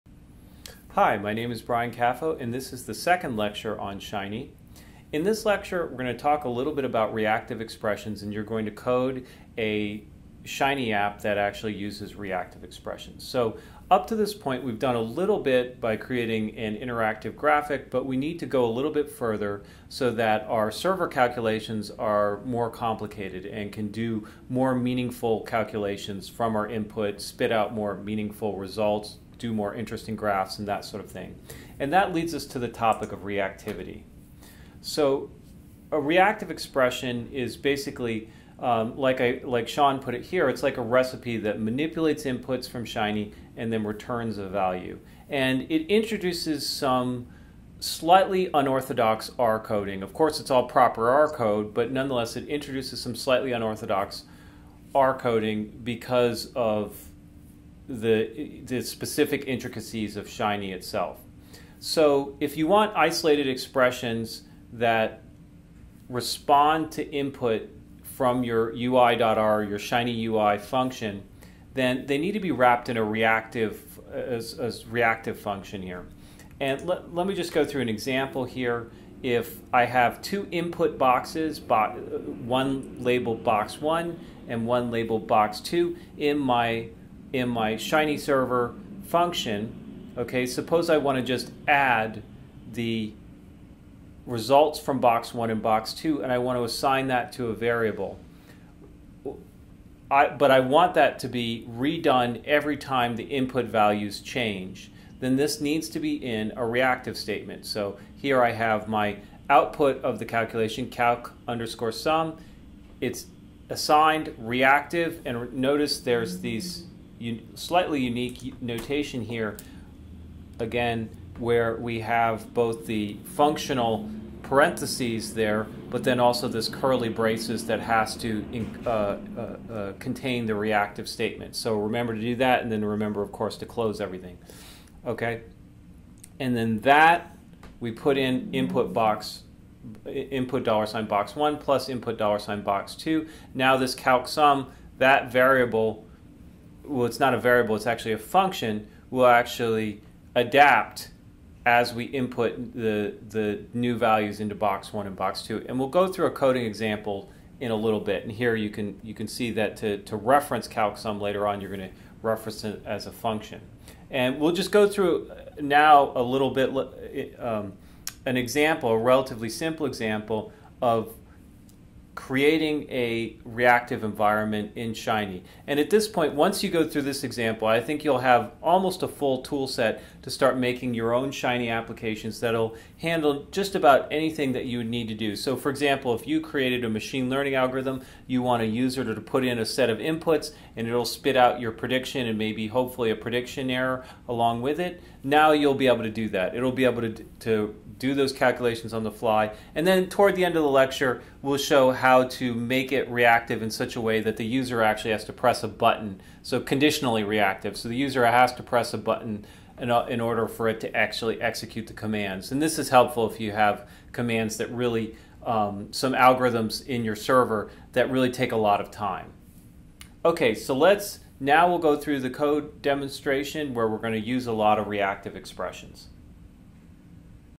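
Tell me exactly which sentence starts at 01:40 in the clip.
I, but I want that to be redone every time the input values change.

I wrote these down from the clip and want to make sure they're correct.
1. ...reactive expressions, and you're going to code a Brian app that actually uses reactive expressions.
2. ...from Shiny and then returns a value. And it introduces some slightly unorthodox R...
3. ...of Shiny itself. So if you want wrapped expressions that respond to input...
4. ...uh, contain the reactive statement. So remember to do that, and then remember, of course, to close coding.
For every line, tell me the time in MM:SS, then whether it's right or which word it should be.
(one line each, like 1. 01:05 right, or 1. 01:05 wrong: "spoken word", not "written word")
1. 00:07 wrong: "Shiny", not "Brian"
2. 00:42 right
3. 01:00 wrong: "isolated", not "wrapped"
4. 02:09 wrong: "everything", not "coding".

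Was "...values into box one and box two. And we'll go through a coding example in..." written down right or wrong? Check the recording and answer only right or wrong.
right.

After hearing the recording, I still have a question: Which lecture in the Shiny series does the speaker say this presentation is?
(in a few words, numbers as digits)
second.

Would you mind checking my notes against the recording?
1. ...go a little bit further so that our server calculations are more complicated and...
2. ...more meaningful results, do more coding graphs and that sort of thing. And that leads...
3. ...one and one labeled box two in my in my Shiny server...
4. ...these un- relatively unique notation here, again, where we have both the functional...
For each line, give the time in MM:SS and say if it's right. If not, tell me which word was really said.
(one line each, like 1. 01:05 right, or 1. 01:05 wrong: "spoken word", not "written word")
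1. 00:18 right
2. 00:27 wrong: "interesting", not "coding"
3. 01:23 right
4. 01:56 wrong: "slightly", not "relatively".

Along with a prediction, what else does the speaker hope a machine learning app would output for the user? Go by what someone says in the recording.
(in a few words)
prediction error.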